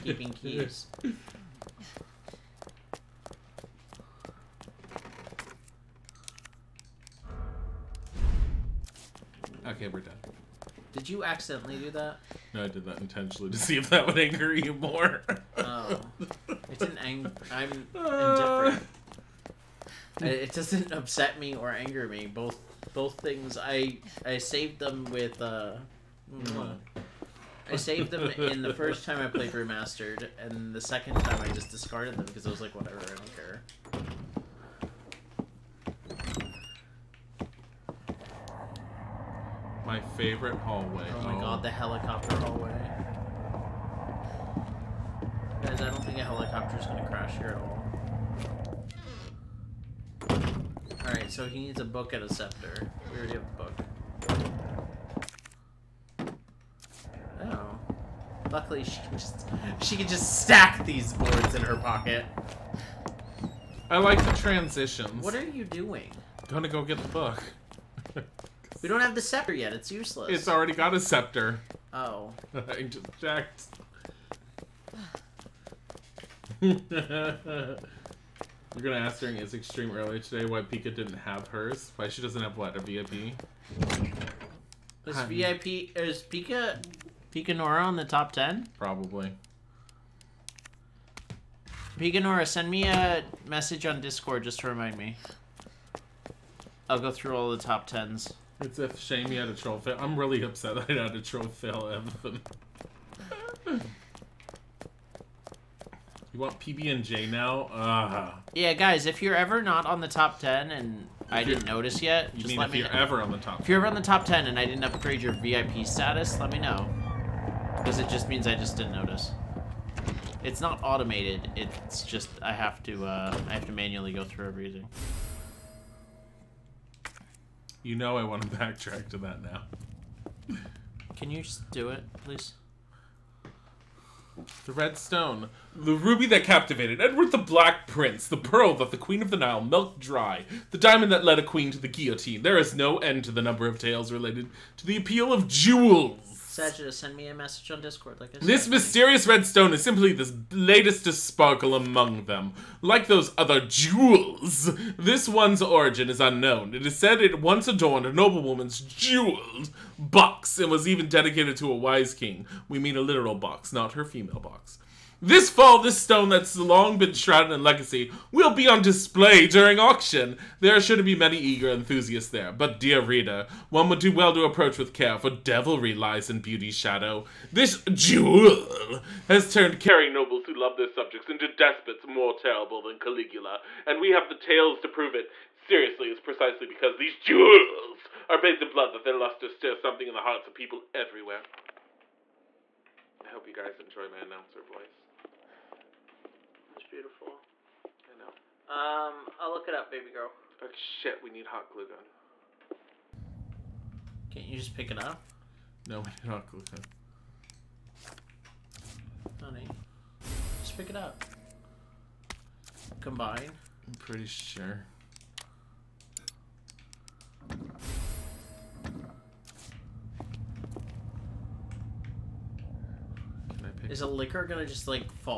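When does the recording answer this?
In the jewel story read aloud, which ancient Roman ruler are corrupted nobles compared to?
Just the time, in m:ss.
3:02.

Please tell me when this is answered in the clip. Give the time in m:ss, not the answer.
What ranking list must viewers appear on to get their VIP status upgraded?
1:28.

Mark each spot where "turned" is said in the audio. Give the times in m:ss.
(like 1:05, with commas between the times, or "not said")
2:59.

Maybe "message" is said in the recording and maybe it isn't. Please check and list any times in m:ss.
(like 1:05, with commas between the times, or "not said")
1:33, 2:27.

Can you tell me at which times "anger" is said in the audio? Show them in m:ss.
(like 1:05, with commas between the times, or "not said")
0:14, 0:21.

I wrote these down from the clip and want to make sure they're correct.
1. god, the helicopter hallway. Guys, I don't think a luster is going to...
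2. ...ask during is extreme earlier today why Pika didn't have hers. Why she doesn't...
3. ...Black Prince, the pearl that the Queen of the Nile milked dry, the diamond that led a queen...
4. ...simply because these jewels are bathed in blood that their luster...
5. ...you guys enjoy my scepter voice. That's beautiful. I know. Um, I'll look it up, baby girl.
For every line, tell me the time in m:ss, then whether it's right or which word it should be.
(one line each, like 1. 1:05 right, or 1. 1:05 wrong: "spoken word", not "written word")
1. 0:41 wrong: "helicopter", not "luster"
2. 1:19 right
3. 2:17 right
4. 3:06 wrong: "precisely", not "simply"
5. 3:13 wrong: "announcer", not "scepter".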